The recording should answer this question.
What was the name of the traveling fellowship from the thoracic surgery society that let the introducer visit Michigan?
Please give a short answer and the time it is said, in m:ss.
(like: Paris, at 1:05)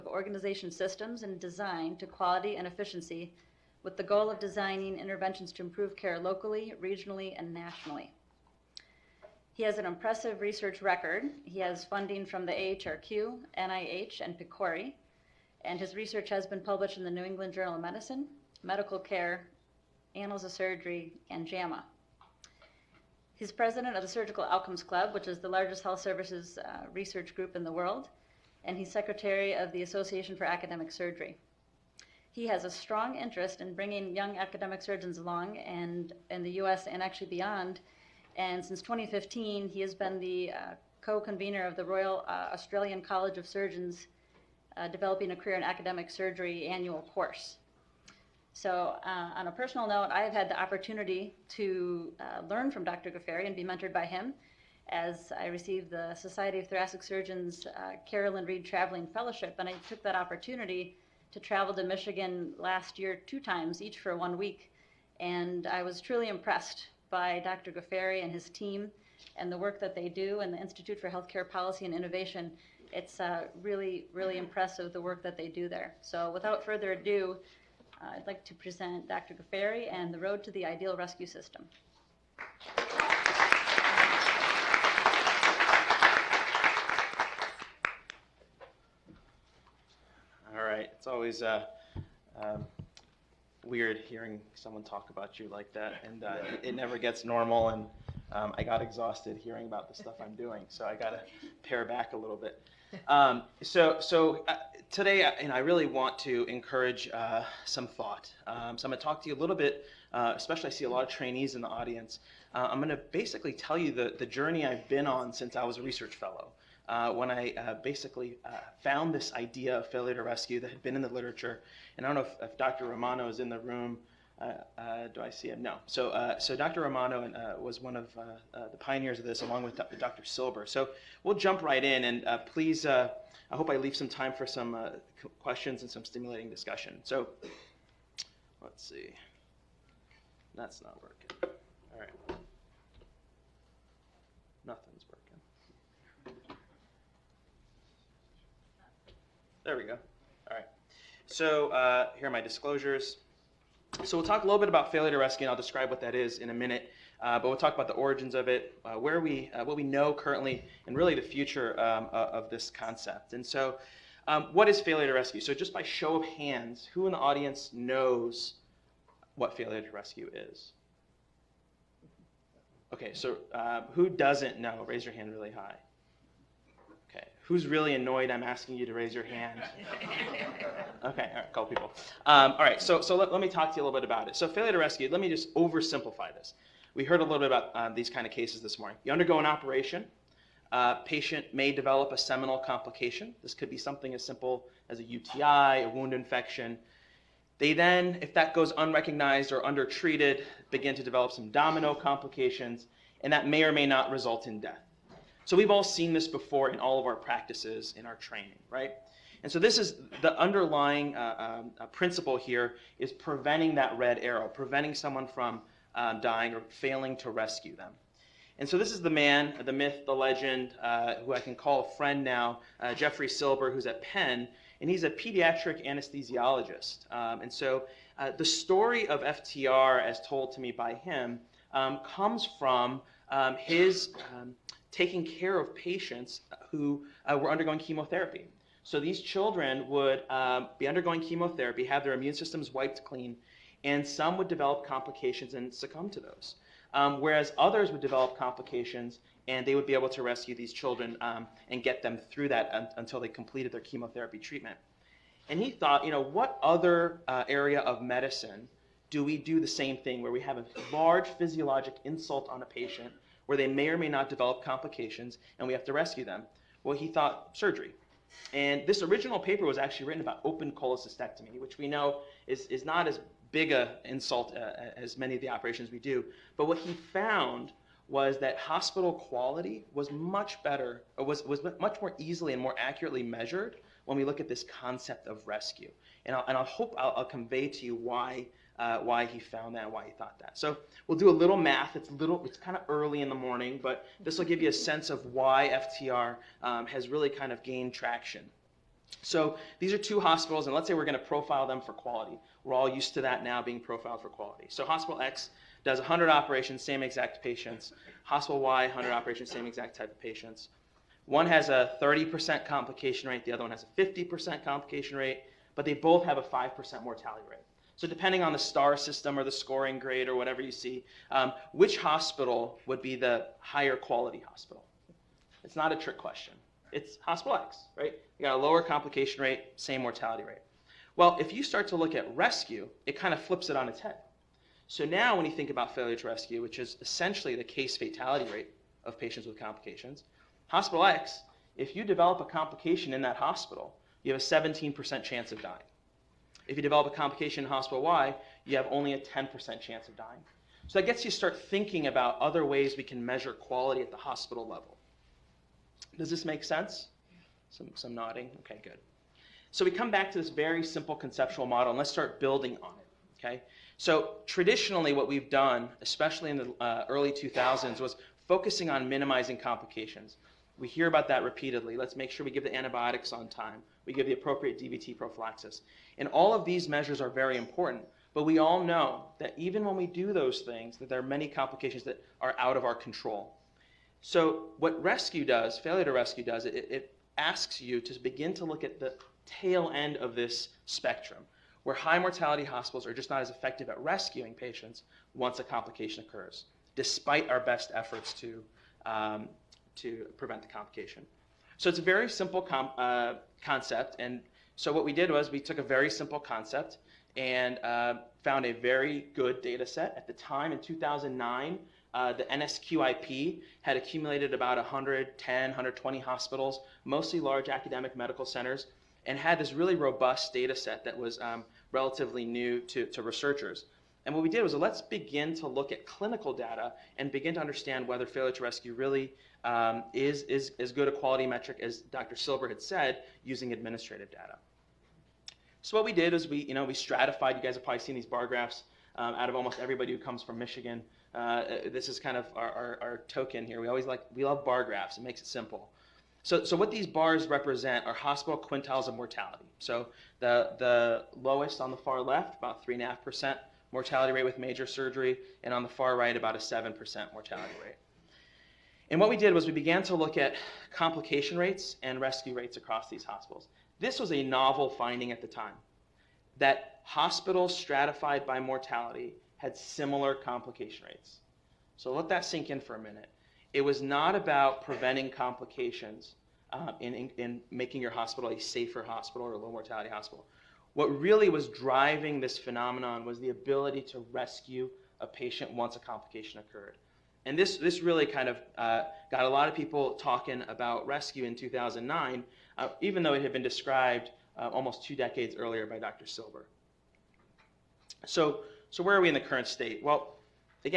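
Carolyn Reed Traveling Fellowship, at 0:58.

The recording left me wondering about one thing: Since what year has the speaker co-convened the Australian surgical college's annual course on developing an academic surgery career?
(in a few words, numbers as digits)
2015.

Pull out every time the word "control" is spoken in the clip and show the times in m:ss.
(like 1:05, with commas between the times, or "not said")
6:22.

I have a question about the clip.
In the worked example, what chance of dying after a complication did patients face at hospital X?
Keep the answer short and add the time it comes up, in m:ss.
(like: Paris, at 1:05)
17%, at 5:44.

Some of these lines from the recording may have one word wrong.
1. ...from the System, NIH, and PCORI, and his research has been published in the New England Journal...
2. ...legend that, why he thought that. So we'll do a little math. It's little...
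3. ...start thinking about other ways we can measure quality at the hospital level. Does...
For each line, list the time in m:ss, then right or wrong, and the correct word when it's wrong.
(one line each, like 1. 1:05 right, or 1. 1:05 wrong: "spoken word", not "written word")
1. 0:12 wrong: "AHRQ", not "System"
2. 4:49 wrong: "found", not "legend"
3. 5:51 right.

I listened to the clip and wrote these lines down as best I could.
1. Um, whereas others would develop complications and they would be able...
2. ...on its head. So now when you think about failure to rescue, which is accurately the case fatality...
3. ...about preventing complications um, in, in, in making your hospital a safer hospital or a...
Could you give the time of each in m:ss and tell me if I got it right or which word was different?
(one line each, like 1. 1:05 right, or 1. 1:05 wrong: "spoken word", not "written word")
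1. 4:06 right
2. 5:33 wrong: "essentially", not "accurately"
3. 7:54 right.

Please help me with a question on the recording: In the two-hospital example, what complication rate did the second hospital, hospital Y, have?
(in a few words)
50%.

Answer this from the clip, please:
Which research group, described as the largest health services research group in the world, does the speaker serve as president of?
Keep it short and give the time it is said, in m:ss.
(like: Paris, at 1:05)
Surgical Outcomes Club, at 0:24.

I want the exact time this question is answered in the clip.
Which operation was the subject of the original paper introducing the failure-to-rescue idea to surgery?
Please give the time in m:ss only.
4:30.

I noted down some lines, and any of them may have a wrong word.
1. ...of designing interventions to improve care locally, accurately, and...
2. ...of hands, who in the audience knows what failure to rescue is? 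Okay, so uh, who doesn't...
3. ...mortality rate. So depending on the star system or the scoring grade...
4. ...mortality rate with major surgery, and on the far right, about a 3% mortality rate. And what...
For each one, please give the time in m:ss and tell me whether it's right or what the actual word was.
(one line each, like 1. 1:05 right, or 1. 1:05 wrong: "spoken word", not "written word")
1. 0:04 wrong: "regionally", not "accurately"
2. 2:46 right
3. 5:17 right
4. 7:33 wrong: "7", not "3".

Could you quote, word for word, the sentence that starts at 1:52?
Uh, I'm going to basically tell you the, the journey I've been on since I was a research fellow.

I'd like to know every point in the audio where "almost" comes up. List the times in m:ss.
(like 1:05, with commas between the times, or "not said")
7:19, 8:14.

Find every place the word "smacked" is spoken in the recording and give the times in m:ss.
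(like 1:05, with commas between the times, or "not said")
not said.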